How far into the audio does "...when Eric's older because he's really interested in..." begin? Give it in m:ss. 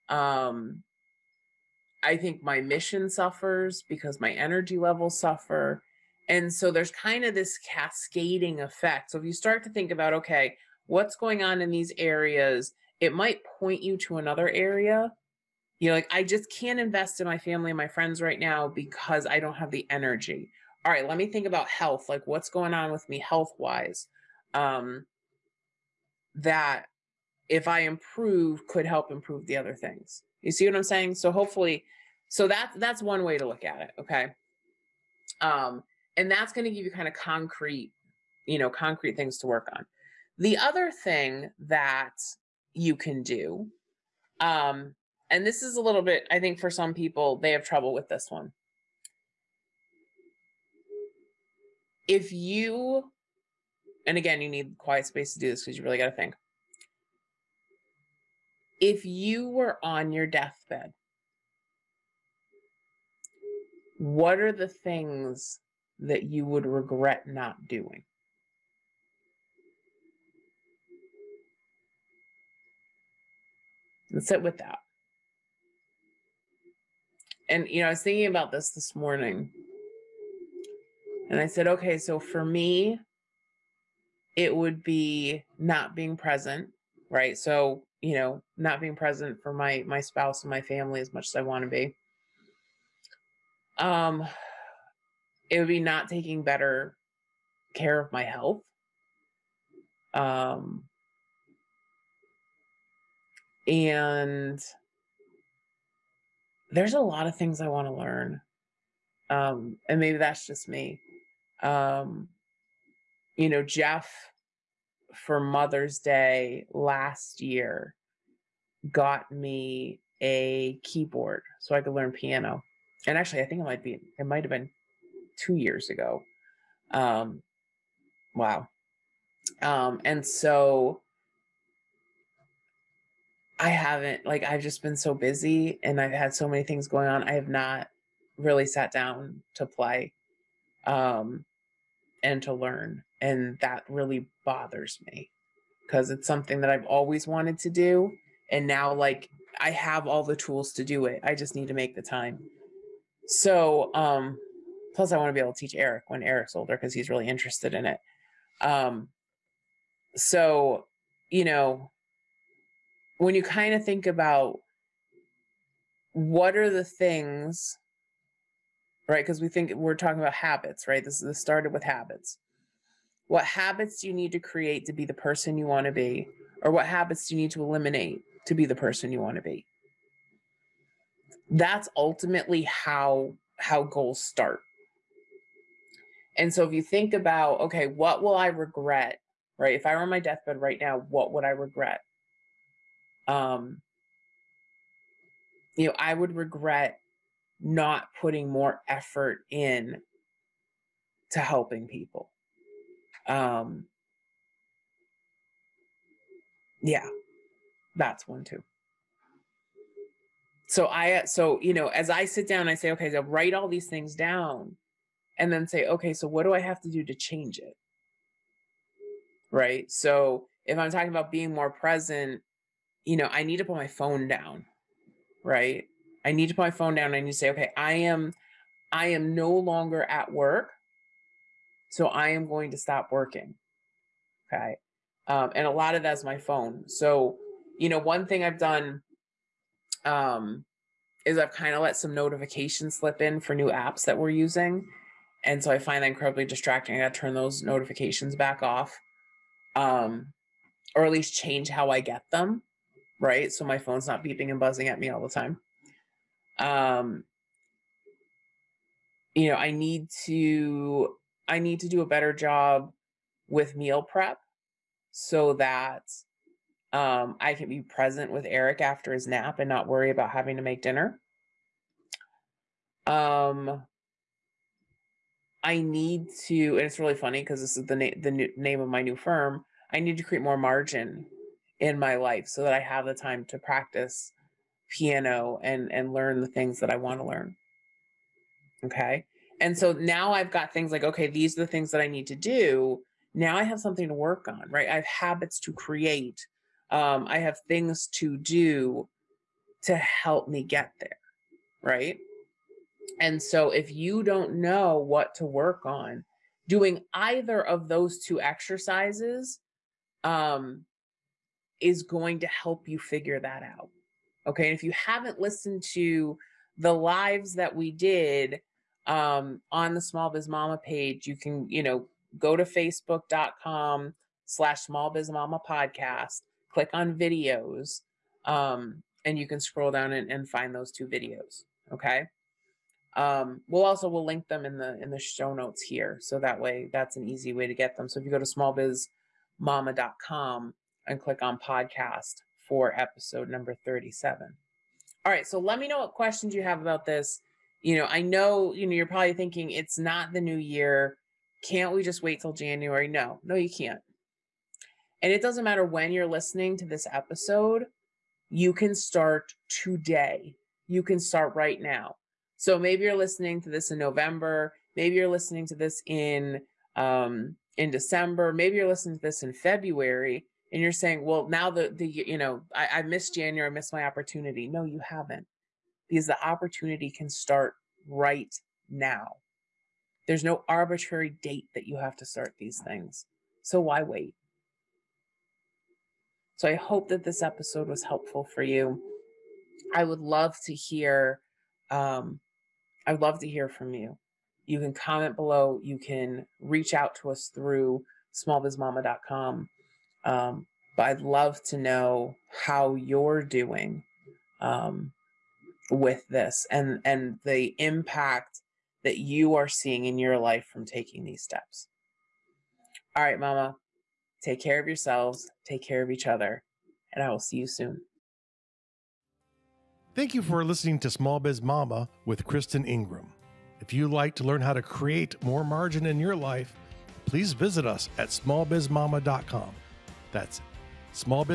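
2:36.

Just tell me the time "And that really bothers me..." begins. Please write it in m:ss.
2:23.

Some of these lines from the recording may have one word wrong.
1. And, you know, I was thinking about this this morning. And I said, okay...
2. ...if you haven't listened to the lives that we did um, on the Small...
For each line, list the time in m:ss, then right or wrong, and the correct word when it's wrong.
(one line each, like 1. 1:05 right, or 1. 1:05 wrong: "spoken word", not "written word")
1. 1:17 right
2. 5:14 right.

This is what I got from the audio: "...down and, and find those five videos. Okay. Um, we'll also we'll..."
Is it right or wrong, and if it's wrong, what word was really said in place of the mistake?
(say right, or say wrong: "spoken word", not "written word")
wrong: "two", not "five".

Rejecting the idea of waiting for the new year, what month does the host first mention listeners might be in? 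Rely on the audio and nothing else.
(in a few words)
November.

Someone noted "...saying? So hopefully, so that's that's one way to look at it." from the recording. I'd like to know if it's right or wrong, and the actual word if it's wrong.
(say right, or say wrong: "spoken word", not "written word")
right.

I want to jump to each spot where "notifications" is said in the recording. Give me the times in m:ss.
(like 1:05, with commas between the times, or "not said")
4:02, 4:07.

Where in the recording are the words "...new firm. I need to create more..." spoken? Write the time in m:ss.
4:39.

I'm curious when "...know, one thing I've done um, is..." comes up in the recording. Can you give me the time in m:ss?
3:57.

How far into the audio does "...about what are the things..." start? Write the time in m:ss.
2:44.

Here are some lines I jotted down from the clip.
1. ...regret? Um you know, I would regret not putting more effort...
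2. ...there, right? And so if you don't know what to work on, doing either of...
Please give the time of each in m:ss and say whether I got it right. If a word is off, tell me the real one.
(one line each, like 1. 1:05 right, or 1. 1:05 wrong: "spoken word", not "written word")
1. 3:11 right
2. 5:01 right.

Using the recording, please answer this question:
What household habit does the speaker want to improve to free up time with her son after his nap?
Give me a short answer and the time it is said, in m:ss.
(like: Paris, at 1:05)
Meal prep, at 4:23.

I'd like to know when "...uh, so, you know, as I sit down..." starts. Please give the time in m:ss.
3:31.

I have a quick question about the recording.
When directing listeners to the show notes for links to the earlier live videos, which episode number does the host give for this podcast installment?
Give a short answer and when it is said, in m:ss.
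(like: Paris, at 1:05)
37, at 5:43.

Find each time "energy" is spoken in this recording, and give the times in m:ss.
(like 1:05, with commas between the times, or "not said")
0:04, 0:19.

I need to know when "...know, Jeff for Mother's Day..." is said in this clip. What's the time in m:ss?
1:53.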